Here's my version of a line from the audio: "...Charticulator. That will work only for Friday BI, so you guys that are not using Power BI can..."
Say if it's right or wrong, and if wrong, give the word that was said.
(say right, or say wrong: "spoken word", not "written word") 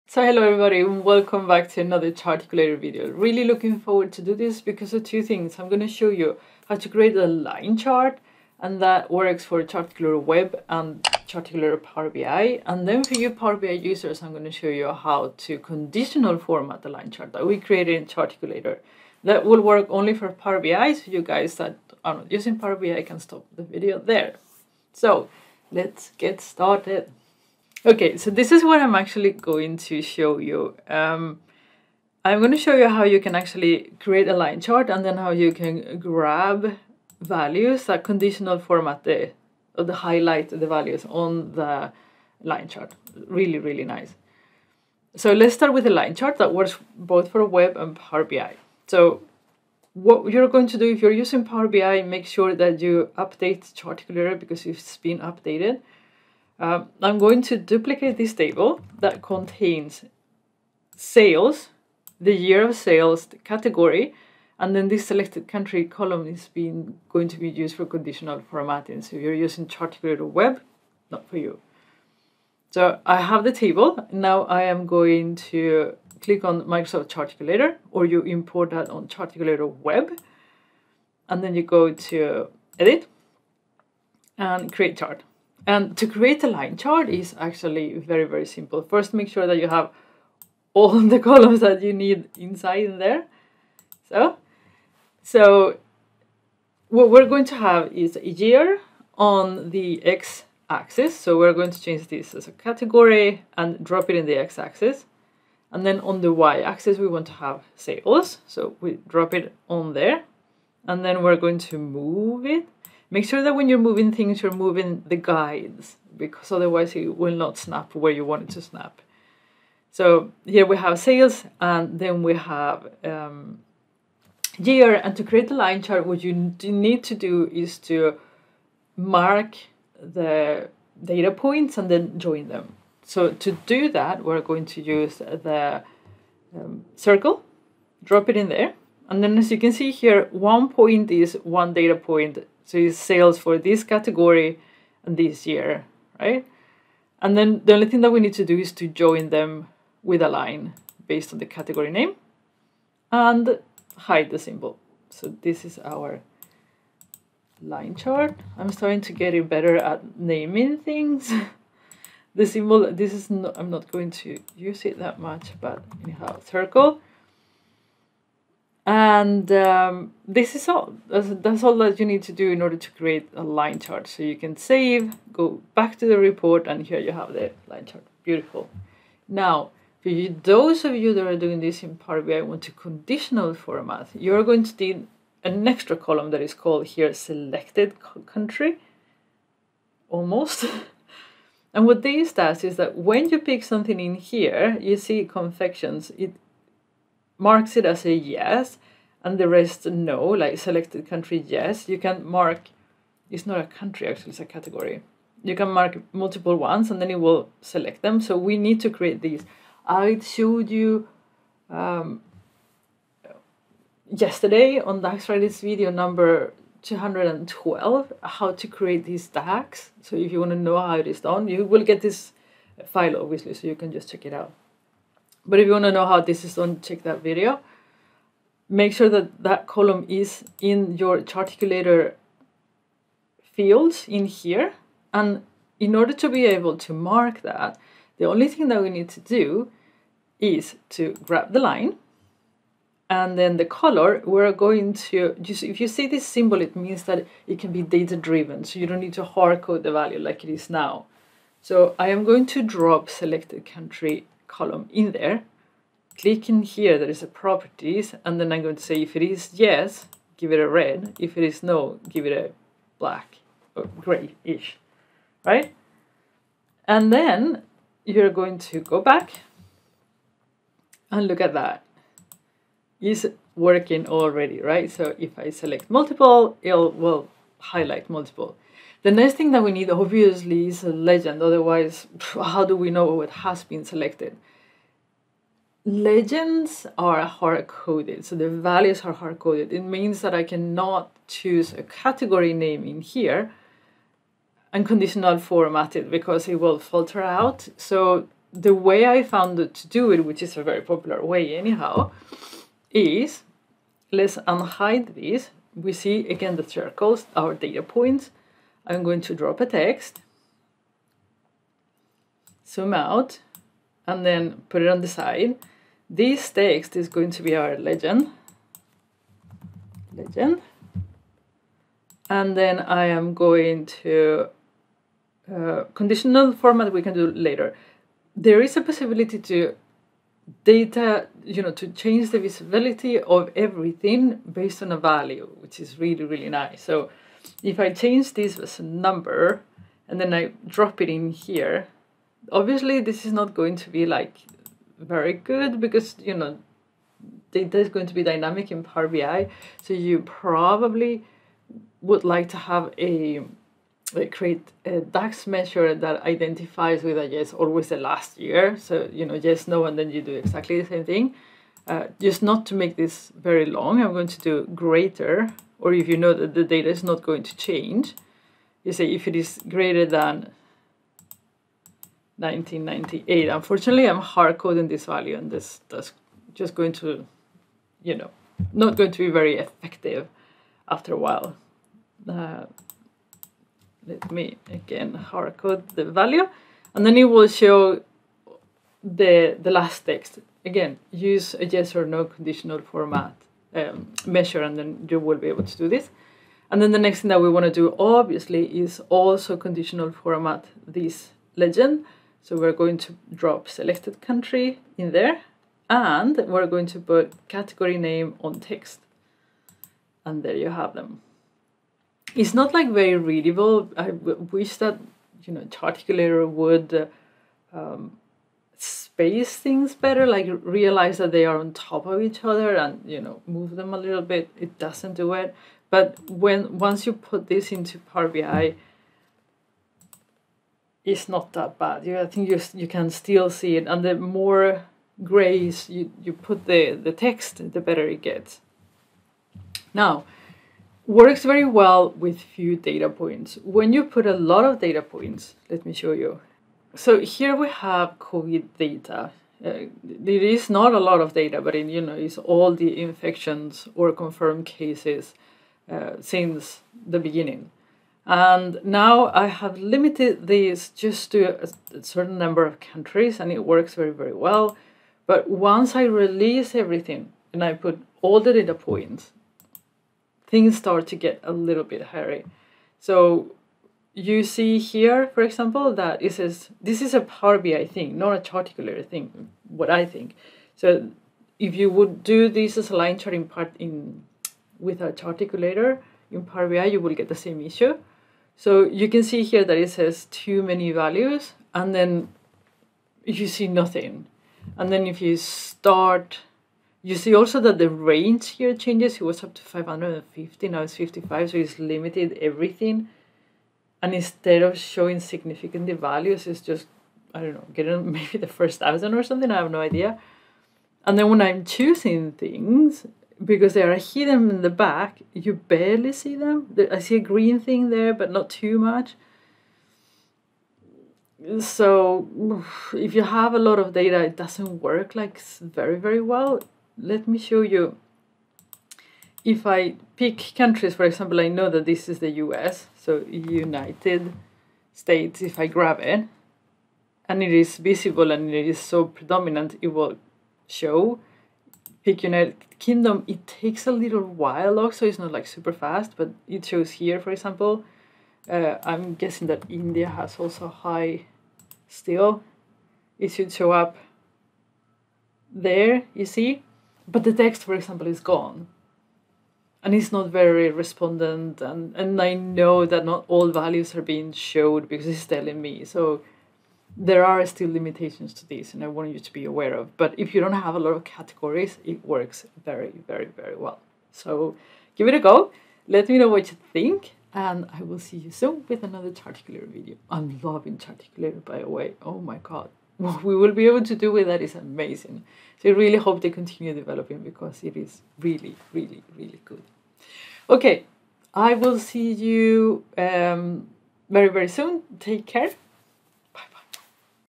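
wrong: "Power", not "Friday".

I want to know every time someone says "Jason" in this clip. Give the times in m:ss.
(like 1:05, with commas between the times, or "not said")
not said.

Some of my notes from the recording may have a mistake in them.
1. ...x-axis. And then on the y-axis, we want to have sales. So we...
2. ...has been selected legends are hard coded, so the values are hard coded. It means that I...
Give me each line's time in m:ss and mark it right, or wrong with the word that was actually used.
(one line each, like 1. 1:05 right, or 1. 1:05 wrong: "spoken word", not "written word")
1. 1:44 right
2. 4:43 right.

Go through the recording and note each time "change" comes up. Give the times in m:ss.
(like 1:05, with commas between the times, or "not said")
1:41, 5:31, 5:37, 6:07, 8:18.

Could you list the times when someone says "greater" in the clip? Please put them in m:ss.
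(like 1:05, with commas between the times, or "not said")
6:04, 6:09.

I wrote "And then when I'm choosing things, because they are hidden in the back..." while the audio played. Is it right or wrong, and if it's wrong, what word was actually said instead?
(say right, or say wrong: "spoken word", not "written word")
right.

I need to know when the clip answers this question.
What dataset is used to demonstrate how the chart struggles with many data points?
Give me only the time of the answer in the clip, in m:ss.
7:28.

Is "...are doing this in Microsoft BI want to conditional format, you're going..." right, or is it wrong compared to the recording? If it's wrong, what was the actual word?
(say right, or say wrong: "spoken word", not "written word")
wrong: "Power", not "Microsoft".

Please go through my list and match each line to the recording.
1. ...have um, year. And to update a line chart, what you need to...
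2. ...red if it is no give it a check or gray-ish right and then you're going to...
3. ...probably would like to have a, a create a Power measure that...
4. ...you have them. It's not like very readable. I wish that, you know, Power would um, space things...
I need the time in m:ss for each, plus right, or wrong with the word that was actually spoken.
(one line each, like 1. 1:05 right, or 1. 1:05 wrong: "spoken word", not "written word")
1. 2:02 wrong: "create", not "update"
2. 4:20 wrong: "black", not "check"
3. 5:50 wrong: "DAX", not "Power"
4. 6:50 wrong: "Charticulator", not "Power".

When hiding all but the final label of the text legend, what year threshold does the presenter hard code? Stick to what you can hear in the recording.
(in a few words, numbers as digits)
1998.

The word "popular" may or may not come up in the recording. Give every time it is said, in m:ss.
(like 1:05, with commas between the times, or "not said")
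5:00.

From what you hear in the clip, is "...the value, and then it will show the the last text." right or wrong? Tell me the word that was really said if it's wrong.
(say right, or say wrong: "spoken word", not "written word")
right.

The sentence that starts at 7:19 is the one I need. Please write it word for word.
Now, works very well with few data points.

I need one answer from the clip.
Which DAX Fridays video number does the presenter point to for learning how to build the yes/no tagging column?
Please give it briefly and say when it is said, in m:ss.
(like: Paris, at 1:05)
212, at 3:36.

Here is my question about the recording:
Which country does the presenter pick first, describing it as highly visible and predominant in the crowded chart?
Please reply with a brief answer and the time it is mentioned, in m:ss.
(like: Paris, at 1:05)
United States, at 8:53.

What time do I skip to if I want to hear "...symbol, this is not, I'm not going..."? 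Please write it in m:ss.
2:42.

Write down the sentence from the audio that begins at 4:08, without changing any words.
So you don't need to hard code the value like it is now.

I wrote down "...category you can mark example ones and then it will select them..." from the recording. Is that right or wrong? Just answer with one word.
wrong.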